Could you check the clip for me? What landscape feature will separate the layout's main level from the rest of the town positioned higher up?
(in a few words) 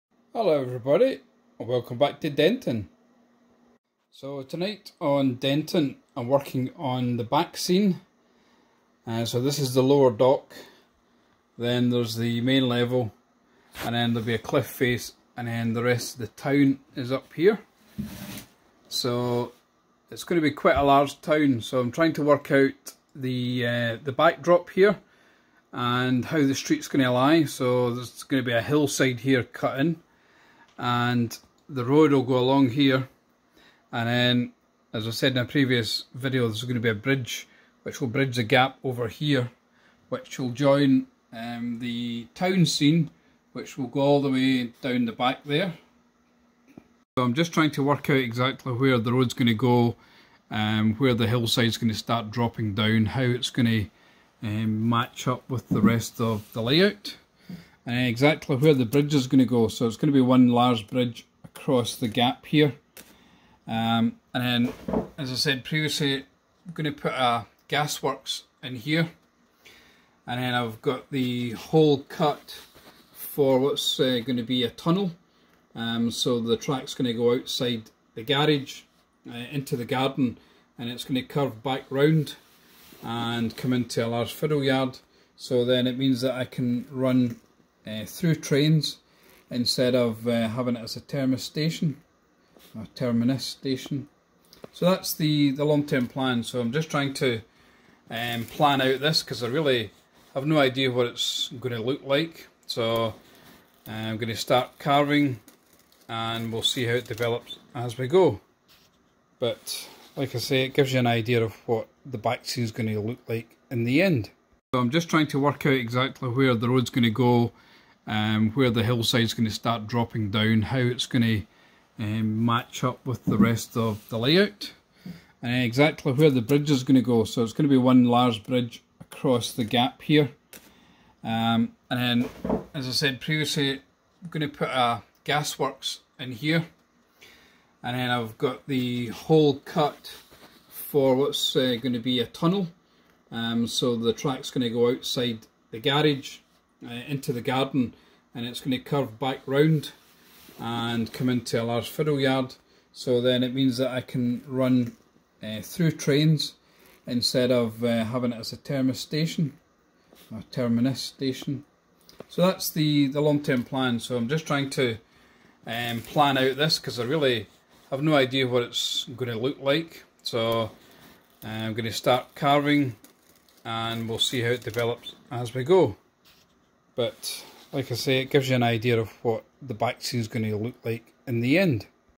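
a cliff face.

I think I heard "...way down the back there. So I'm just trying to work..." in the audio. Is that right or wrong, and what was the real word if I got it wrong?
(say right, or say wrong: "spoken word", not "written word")
right.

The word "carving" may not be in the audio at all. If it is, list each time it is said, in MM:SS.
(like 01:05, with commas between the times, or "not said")
01:44, 02:52.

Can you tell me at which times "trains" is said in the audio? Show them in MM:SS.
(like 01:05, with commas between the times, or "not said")
01:28, 02:35.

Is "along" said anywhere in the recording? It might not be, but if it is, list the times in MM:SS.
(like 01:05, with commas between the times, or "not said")
00:32.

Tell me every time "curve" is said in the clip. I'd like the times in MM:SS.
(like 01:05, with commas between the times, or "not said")
01:21, 02:28.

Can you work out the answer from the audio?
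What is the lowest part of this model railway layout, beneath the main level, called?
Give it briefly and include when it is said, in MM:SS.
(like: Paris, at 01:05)
lower dock, at 00:09.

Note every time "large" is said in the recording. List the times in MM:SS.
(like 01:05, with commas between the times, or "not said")
00:20, 01:00, 01:24, 02:08, 02:31.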